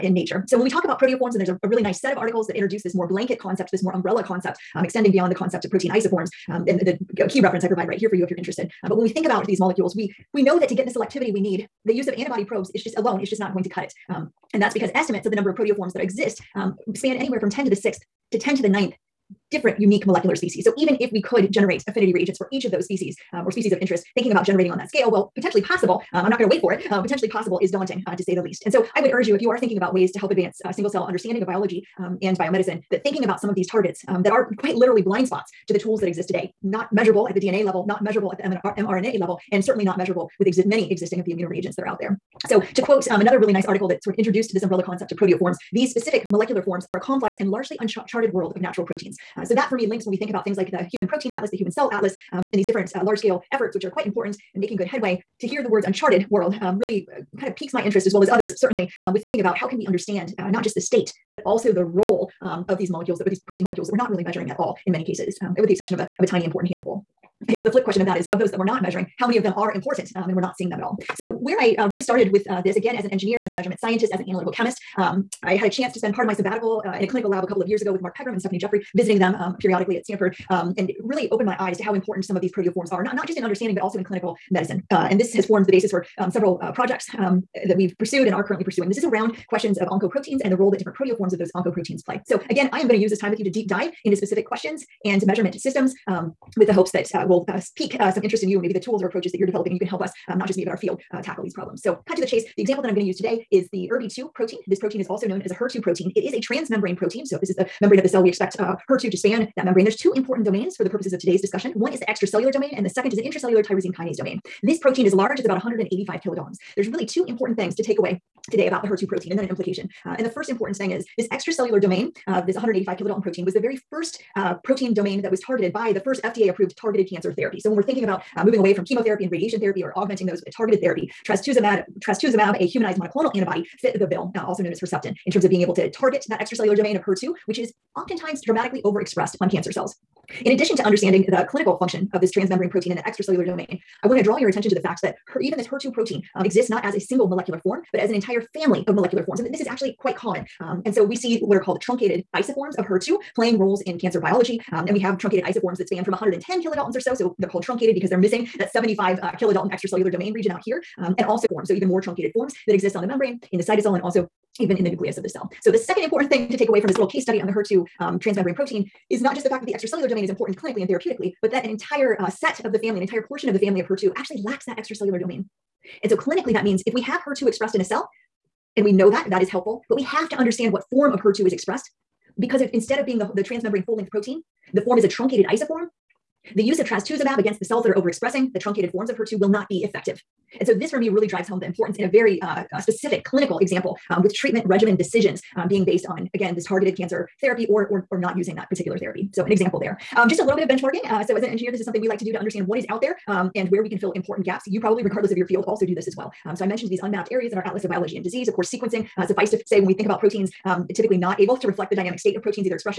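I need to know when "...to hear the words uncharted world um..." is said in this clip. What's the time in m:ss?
0:55.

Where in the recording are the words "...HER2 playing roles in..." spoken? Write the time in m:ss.
2:32.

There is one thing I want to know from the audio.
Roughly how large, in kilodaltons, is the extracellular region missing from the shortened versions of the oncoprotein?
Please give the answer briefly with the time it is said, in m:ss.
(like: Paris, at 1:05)
75 kilodaltons, at 2:38.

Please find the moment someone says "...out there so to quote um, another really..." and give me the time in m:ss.
0:41.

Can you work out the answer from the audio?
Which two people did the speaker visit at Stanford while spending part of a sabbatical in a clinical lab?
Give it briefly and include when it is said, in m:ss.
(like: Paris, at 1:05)
Mark Pegram and Stefanie Jeffrey, at 1:18.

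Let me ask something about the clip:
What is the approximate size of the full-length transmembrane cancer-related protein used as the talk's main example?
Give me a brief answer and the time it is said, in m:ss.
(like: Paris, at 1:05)
185 kilodaltons, at 1:55.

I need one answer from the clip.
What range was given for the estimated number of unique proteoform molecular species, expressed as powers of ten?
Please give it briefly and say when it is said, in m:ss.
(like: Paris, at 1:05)
10^6 to 10^9, at 0:17.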